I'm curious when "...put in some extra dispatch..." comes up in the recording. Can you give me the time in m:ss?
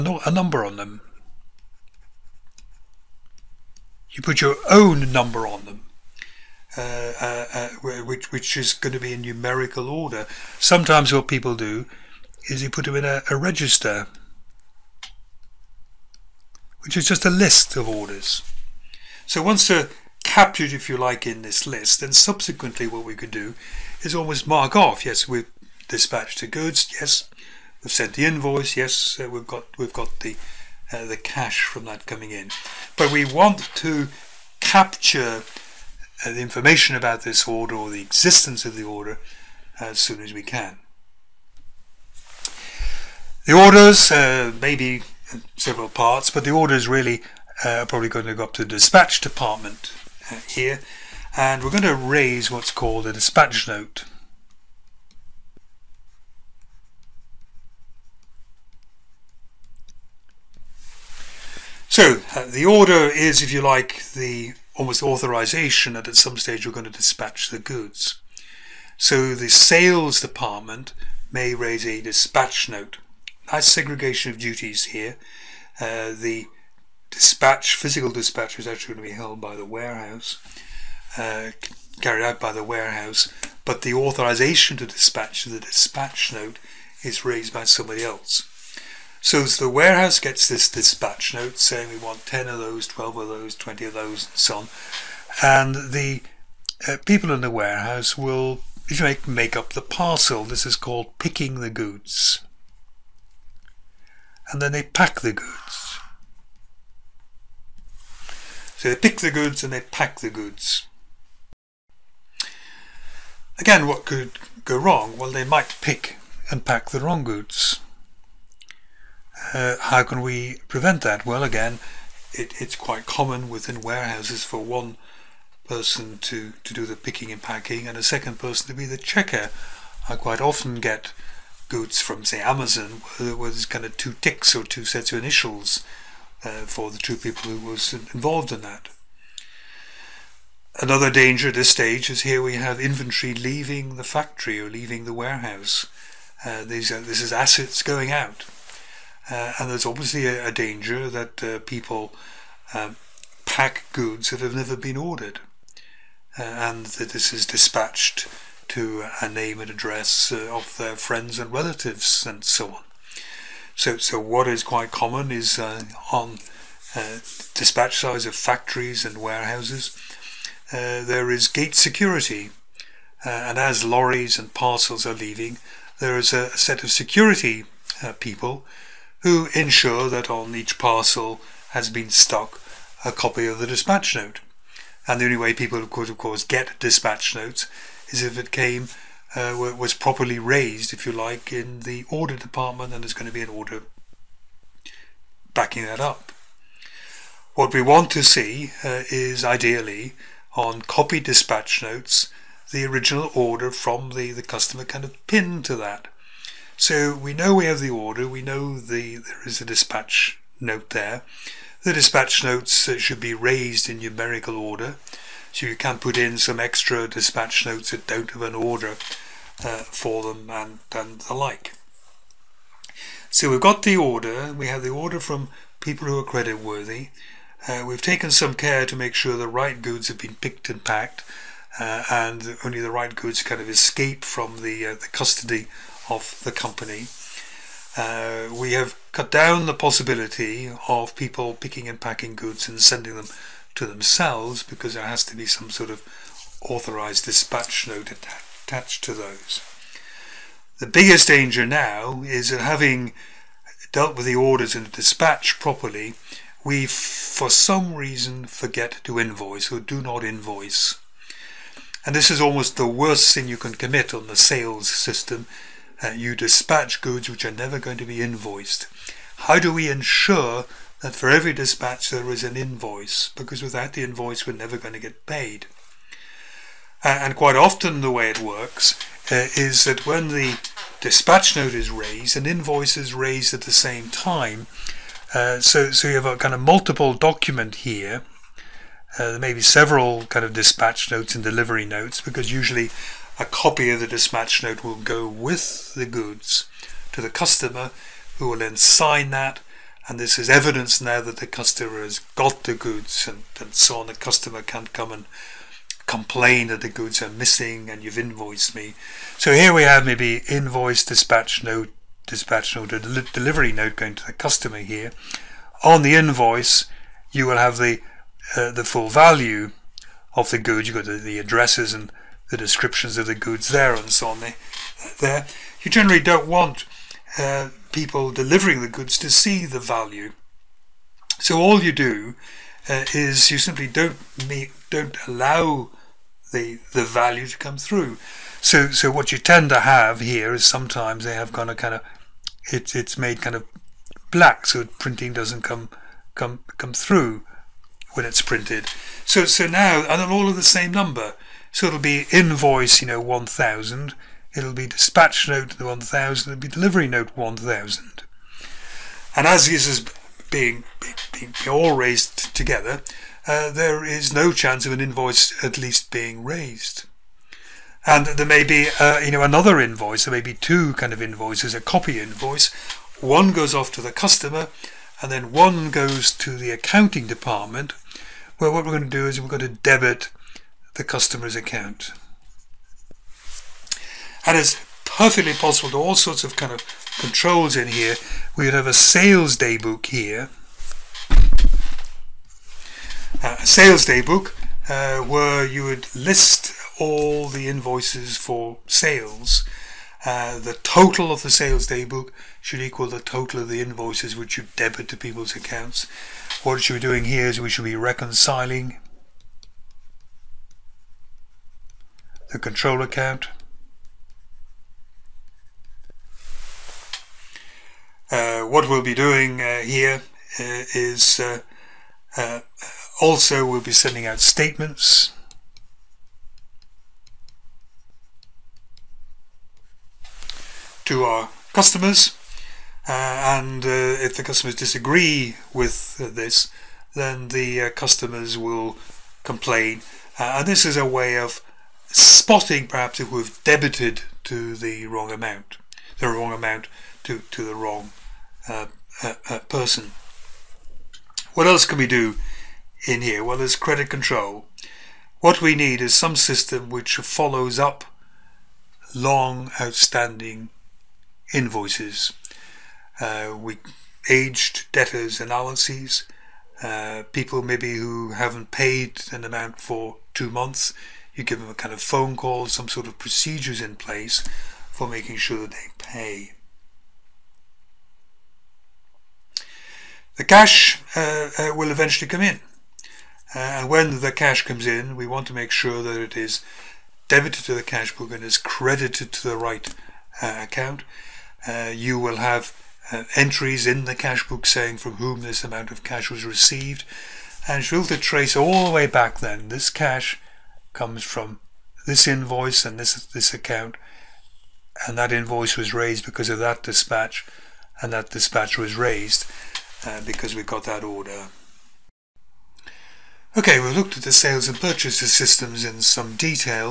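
3:35.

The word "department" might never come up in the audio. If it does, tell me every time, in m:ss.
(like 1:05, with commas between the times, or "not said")
0:49, 1:10, 3:12, 6:17.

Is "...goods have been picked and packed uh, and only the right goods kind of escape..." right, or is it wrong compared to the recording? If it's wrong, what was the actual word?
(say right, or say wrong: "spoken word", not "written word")
right.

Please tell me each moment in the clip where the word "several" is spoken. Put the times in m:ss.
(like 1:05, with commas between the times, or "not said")
0:45, 4:49.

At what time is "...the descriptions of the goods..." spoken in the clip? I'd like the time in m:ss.
5:22.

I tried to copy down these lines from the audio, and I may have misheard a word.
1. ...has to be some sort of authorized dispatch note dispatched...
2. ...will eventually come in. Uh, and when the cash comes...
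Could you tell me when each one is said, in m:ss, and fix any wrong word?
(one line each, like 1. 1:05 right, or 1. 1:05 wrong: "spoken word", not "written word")
1. 4:05 wrong: "attached", not "dispatched"
2. 8:01 right.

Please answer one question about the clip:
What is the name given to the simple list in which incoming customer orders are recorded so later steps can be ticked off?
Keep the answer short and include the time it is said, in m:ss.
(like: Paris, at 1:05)
register, at 0:13.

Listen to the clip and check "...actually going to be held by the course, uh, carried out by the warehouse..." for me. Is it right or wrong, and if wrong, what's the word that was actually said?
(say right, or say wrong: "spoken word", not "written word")
wrong: "warehouse", not "course".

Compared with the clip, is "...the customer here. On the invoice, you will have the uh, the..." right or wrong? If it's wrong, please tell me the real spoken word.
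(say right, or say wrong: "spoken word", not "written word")
right.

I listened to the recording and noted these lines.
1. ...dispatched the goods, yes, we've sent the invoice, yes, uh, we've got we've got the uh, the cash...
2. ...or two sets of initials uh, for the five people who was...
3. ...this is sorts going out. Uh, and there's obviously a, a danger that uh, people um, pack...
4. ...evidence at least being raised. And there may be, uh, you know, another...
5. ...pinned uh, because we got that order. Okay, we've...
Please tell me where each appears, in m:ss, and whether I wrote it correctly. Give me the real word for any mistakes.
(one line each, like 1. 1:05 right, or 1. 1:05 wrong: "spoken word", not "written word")
1. 0:25 right
2. 2:14 wrong: "two", not "five"
3. 2:27 wrong: "assets", not "sorts"
4. 6:04 wrong: "invoice", not "evidence"
5. 8:28 wrong: "raised", not "pinned".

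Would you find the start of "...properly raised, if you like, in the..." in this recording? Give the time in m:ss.
3:09.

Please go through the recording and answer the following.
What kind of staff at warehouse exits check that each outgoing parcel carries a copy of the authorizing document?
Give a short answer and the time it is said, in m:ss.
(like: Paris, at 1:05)
gate security, at 2:51.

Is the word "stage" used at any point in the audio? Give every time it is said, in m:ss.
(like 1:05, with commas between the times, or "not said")
1:06, 2:21.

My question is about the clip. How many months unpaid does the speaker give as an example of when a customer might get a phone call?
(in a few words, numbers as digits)
2.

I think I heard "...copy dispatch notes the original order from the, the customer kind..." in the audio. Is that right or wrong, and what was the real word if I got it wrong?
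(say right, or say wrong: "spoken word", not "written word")
right.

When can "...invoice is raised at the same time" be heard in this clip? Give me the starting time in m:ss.
4:42.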